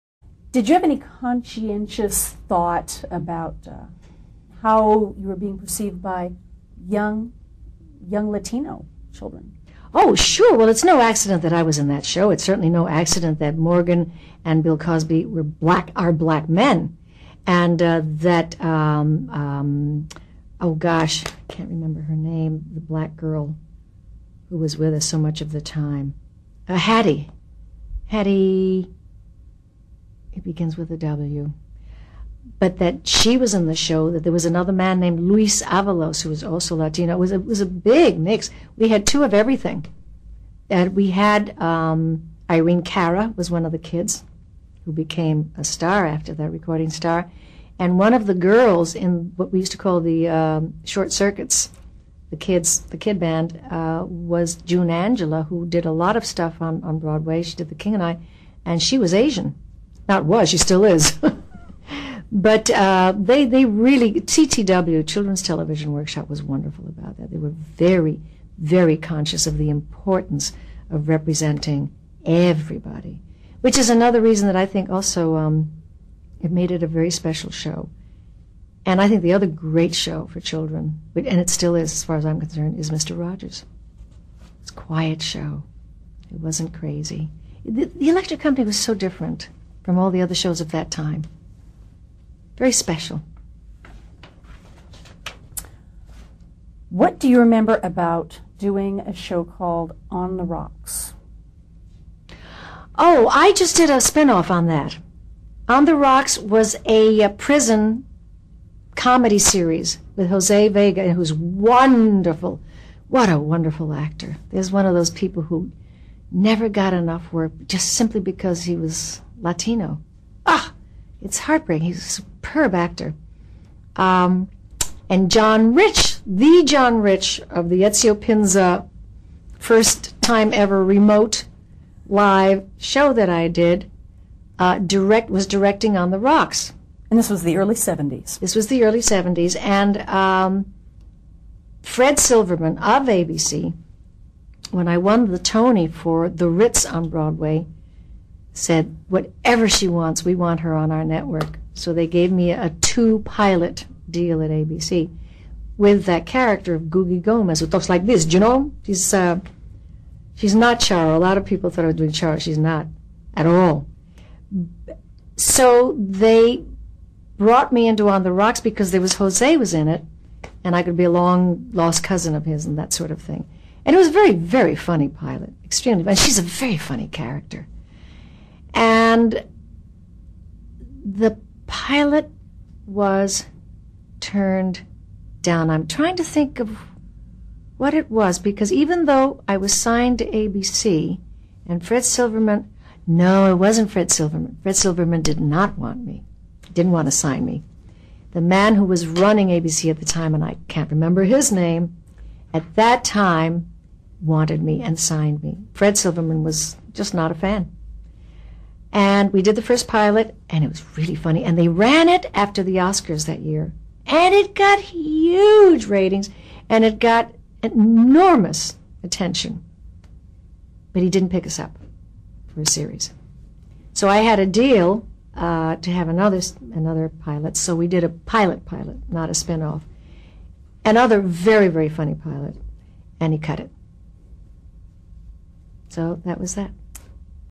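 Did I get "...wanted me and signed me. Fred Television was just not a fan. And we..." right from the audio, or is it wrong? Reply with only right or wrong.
wrong.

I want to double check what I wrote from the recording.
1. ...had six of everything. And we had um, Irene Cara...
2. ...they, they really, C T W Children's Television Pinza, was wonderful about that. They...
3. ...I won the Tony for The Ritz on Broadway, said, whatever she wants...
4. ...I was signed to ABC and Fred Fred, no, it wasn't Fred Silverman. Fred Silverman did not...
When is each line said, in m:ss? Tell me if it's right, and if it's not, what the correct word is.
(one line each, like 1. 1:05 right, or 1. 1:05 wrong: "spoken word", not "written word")
1. 0:38 wrong: "two", not "six"
2. 1:03 wrong: "Workshop", not "Pinza"
3. 2:24 right
4. 3:09 wrong: "Silverman", not "Fred".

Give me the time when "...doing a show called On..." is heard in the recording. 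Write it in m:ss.
1:38.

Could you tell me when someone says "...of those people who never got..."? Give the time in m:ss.
1:54.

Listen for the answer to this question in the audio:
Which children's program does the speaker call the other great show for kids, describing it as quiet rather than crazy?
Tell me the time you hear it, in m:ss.
1:22.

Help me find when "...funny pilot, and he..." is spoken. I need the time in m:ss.
3:51.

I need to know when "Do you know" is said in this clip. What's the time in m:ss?
2:38.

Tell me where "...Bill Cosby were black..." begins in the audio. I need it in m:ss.
0:14.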